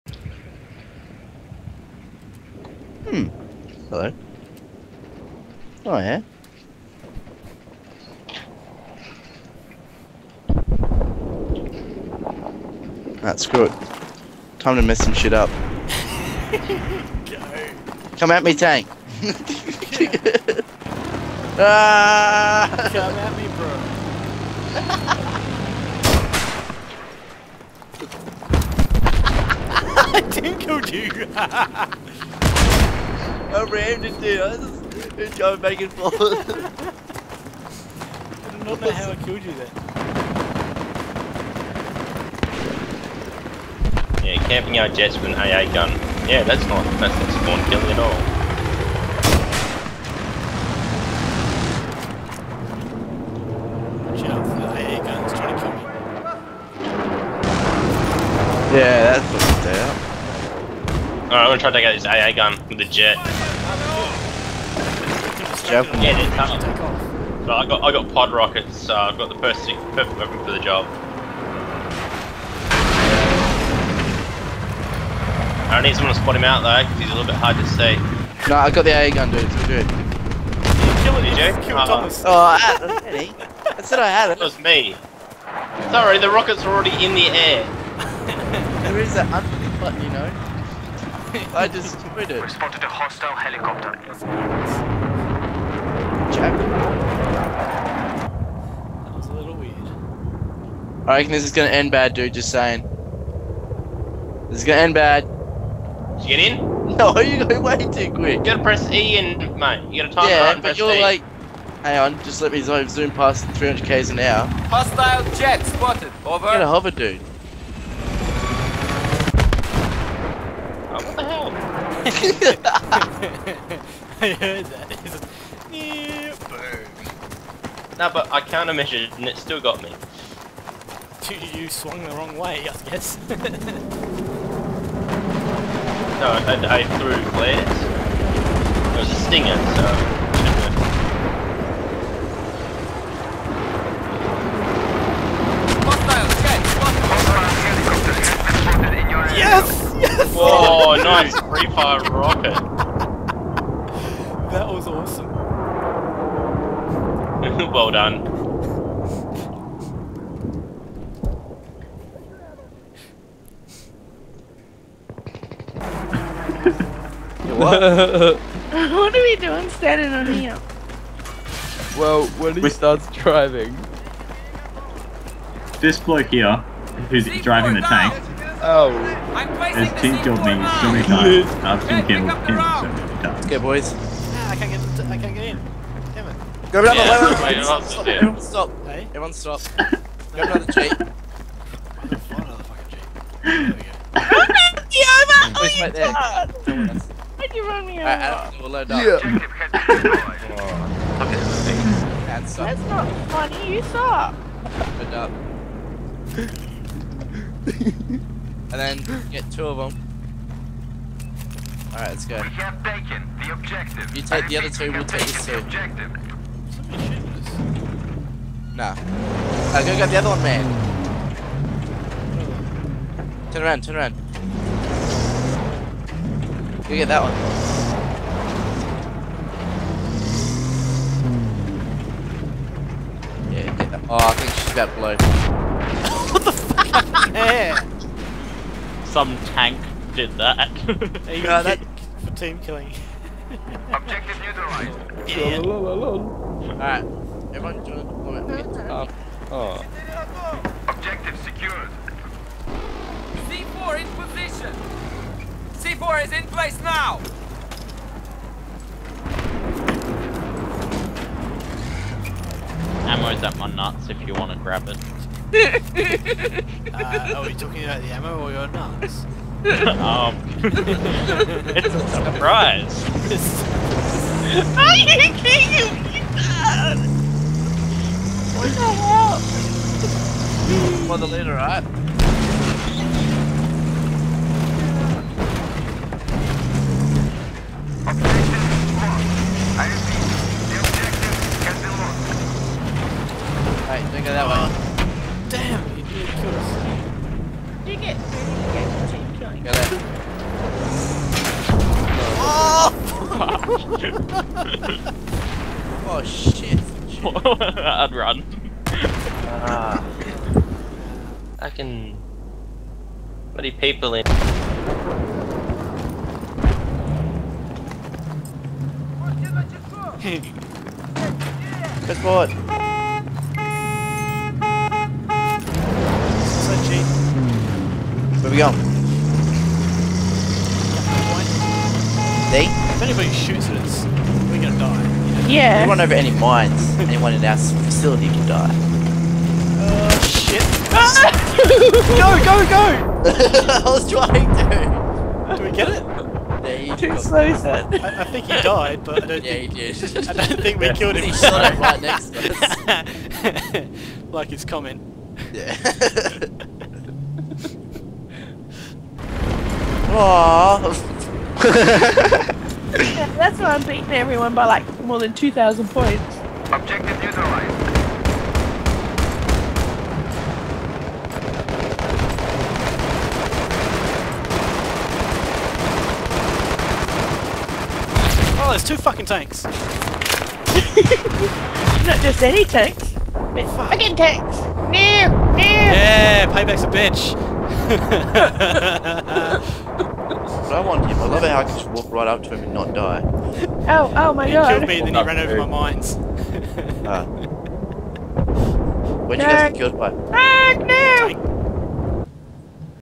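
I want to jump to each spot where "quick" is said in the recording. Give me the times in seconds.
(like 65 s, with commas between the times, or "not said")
108 s.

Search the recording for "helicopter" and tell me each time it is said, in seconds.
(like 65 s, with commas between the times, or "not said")
93 s.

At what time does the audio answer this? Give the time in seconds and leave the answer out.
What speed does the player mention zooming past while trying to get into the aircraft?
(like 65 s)
113 s.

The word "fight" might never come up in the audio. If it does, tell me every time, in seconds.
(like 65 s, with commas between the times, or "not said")
not said.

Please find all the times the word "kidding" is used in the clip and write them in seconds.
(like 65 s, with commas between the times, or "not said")
275 s.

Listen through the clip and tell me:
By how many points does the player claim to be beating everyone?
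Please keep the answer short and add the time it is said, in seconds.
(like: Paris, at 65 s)
More than 2,000, at 365 s.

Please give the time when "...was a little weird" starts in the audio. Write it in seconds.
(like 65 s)
99 s.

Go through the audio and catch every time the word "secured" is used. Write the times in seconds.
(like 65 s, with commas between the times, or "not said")
251 s.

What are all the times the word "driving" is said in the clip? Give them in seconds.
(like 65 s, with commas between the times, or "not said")
173 s, 177 s.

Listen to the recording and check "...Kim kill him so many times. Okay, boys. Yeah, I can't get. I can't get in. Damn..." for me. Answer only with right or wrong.
right.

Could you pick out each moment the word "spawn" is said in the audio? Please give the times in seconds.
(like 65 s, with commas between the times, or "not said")
47 s.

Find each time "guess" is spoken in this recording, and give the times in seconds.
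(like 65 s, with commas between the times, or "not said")
132 s, 314 s.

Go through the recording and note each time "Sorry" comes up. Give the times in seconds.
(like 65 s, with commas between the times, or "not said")
85 s.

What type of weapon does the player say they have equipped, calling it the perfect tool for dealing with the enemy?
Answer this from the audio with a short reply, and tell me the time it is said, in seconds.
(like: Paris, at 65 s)
Pod rockets, at 68 s.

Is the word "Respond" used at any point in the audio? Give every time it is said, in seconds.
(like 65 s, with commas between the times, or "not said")
92 s.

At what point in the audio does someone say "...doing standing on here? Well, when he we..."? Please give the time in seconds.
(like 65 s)
169 s.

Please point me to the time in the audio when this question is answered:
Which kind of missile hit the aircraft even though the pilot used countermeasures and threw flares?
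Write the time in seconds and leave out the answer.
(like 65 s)
139 s.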